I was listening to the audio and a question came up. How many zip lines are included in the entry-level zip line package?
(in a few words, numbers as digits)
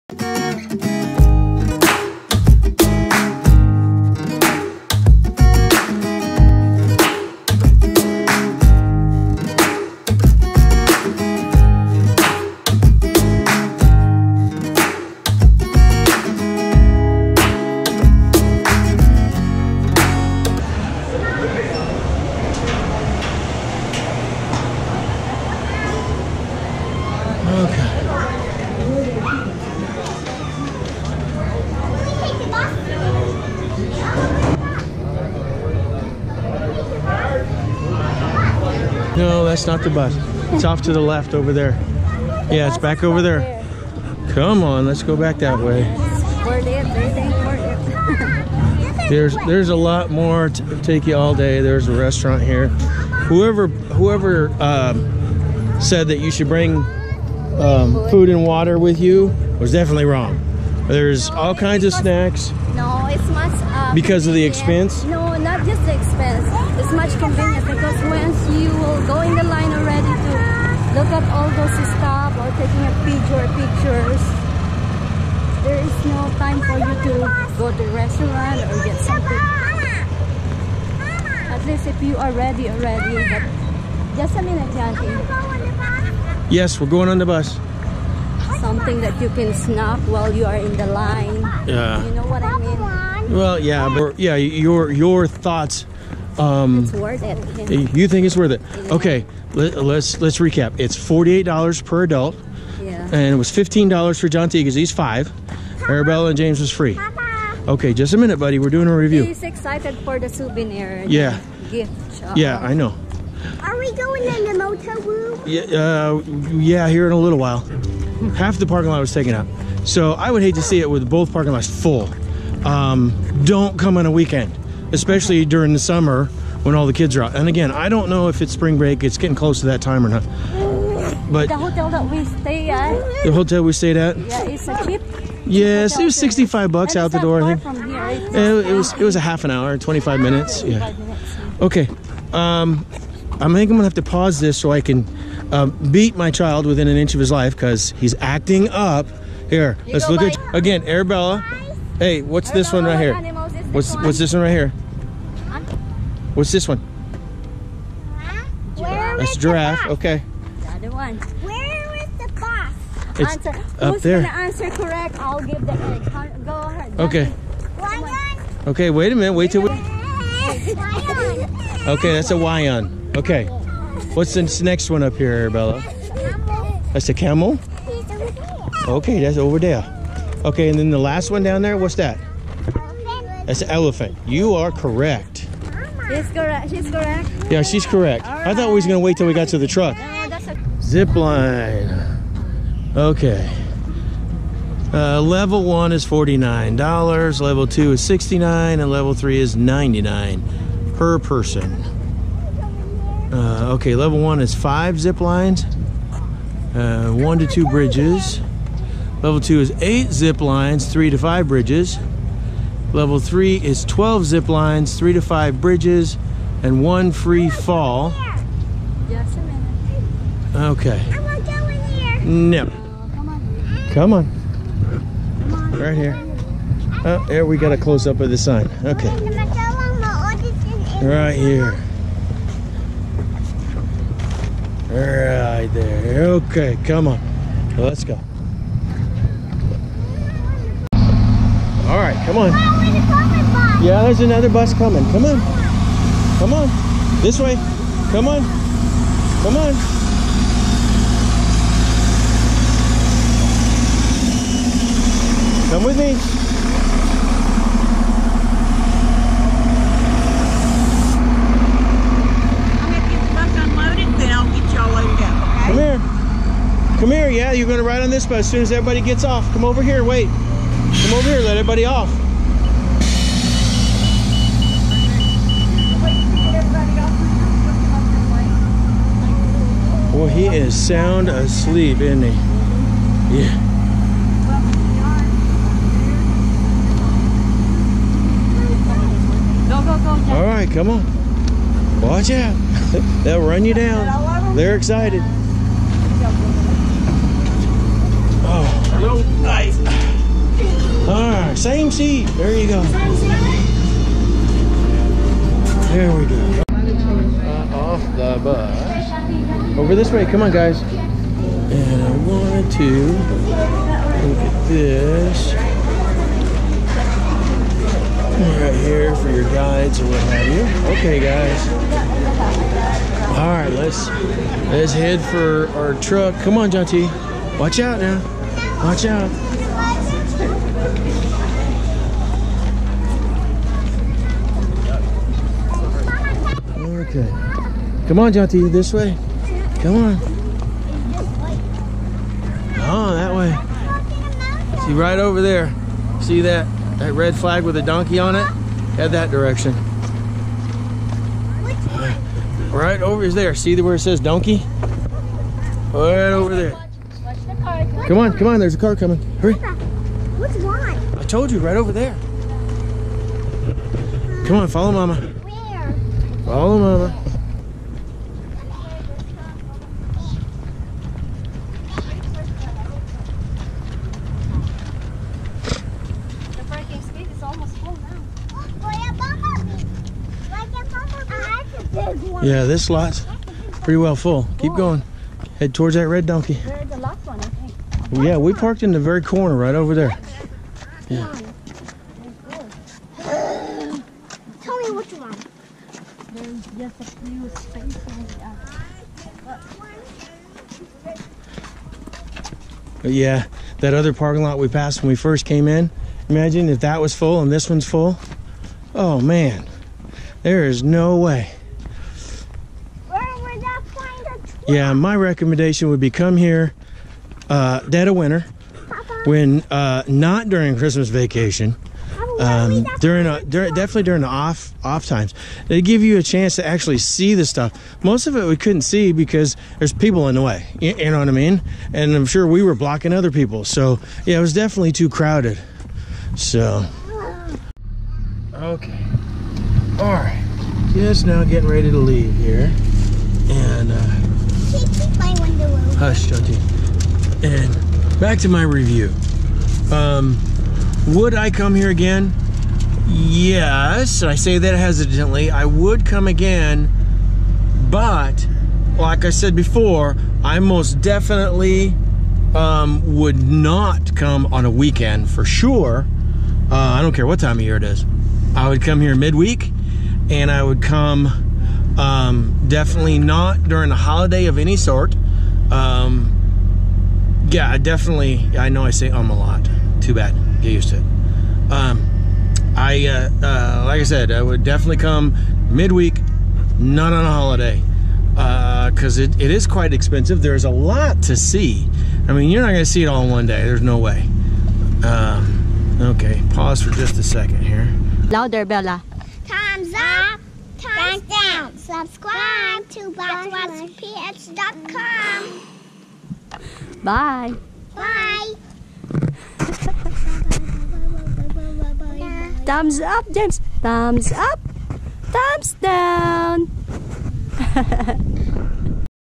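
5.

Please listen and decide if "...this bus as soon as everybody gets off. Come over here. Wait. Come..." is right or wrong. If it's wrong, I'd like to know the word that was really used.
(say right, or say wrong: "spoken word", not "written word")
right.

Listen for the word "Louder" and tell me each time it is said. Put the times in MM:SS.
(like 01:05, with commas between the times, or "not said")
08:18.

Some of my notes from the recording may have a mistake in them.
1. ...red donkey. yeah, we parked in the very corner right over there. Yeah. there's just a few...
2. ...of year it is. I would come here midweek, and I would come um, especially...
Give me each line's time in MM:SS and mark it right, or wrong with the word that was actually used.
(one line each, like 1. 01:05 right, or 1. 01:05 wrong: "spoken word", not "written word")
1. 06:26 right
2. 07:47 wrong: "definitely", not "especially".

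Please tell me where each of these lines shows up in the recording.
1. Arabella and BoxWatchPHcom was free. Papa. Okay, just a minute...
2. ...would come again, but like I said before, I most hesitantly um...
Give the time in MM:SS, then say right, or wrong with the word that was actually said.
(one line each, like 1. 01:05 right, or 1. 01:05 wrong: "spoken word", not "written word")
1. 01:45 wrong: "James", not "BoxWatchPHcom"
2. 07:35 wrong: "definitely", not "hesitantly".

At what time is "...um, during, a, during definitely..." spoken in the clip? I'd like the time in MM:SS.
07:02.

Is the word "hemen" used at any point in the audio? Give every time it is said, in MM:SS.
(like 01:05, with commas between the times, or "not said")
06:06.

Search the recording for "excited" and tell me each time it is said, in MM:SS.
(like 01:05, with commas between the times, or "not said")
01:49, 04:54.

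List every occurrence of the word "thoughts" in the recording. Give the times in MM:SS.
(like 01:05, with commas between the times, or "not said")
01:35, 03:08.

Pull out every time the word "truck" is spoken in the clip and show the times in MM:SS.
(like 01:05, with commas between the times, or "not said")
03:09, 05:25.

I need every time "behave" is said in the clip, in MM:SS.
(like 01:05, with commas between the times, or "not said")
not said.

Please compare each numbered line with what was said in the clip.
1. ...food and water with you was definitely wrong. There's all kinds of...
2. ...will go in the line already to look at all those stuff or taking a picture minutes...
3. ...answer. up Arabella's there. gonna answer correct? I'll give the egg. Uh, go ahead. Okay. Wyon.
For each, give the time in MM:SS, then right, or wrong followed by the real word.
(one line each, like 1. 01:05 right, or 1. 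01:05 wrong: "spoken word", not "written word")
1. 00:58 right
2. 01:08 wrong: "pictures", not "minutes"
3. 02:43 wrong: "Who", not "Arabella".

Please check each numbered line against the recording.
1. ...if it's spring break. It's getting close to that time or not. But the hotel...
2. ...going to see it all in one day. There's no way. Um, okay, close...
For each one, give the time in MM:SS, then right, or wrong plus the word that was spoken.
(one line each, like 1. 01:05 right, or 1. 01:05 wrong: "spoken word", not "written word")
1. 02:08 right
2. 08:12 wrong: "pause", not "close".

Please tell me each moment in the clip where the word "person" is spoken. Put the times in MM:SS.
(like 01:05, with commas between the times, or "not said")
03:21.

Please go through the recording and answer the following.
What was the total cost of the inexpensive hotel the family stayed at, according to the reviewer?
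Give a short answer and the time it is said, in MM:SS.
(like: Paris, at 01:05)
$65, at 02:16.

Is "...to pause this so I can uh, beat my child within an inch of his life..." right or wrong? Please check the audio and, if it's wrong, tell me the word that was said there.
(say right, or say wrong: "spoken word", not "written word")
right.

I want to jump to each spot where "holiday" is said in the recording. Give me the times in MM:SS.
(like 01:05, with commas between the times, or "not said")
07:53, 08:07.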